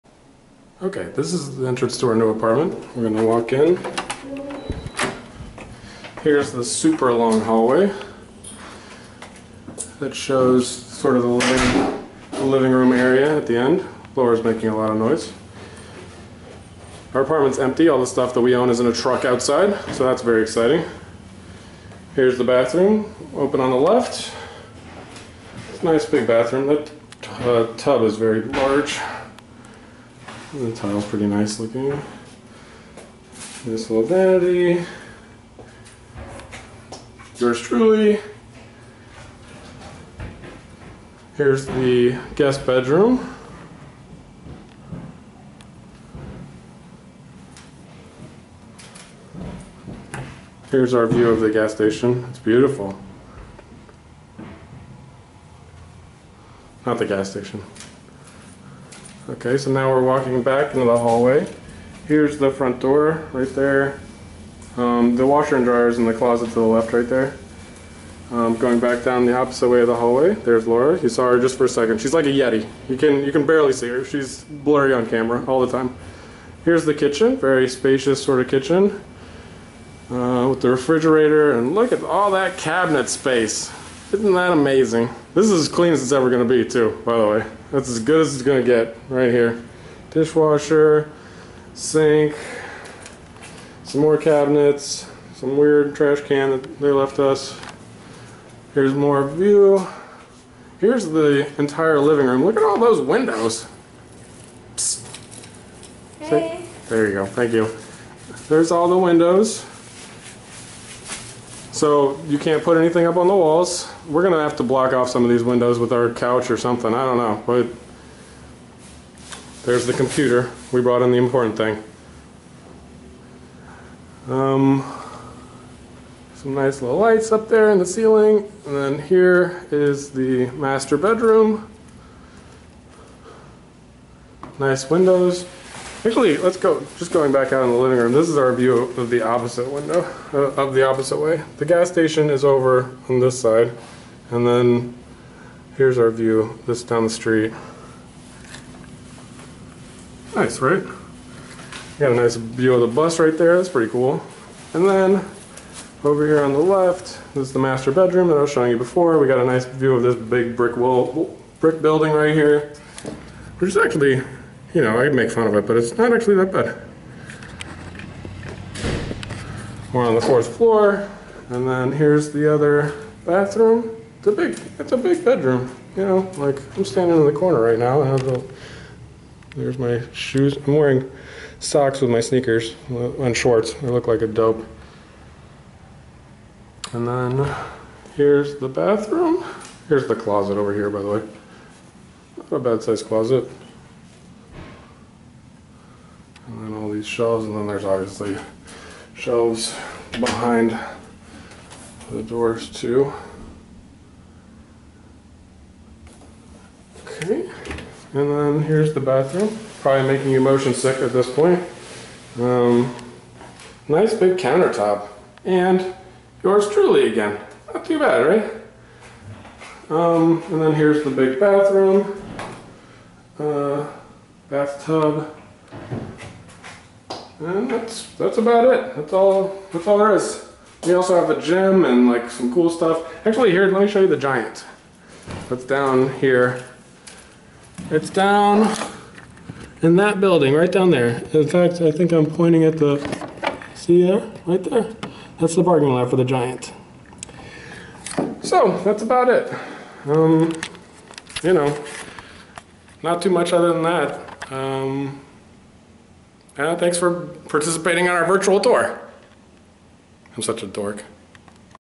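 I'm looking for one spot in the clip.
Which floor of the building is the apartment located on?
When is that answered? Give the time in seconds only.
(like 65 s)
170 s.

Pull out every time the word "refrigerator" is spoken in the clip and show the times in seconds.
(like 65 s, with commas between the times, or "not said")
80 s.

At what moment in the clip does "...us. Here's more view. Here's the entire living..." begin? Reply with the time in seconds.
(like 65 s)
97 s.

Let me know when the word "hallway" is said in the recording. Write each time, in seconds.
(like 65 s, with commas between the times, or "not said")
7 s, 60 s, 69 s.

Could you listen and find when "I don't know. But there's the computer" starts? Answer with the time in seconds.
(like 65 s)
116 s.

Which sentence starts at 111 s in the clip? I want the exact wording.
So you can't put anything up on the walls.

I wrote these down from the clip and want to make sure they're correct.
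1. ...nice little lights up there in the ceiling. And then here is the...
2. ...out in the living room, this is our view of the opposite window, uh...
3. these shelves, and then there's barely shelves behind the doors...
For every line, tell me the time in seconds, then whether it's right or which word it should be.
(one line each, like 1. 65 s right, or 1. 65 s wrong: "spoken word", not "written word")
1. 126 s right
2. 137 s right
3. 197 s wrong: "obviously", not "barely".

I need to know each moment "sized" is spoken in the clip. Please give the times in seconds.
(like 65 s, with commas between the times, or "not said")
192 s.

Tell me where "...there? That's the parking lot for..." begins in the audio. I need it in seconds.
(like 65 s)
244 s.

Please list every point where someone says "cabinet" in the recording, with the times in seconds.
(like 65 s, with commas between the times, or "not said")
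82 s, 94 s.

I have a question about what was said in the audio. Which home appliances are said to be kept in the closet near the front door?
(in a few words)
Washer and dryer.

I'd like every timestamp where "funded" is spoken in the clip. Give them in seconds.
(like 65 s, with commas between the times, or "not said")
not said.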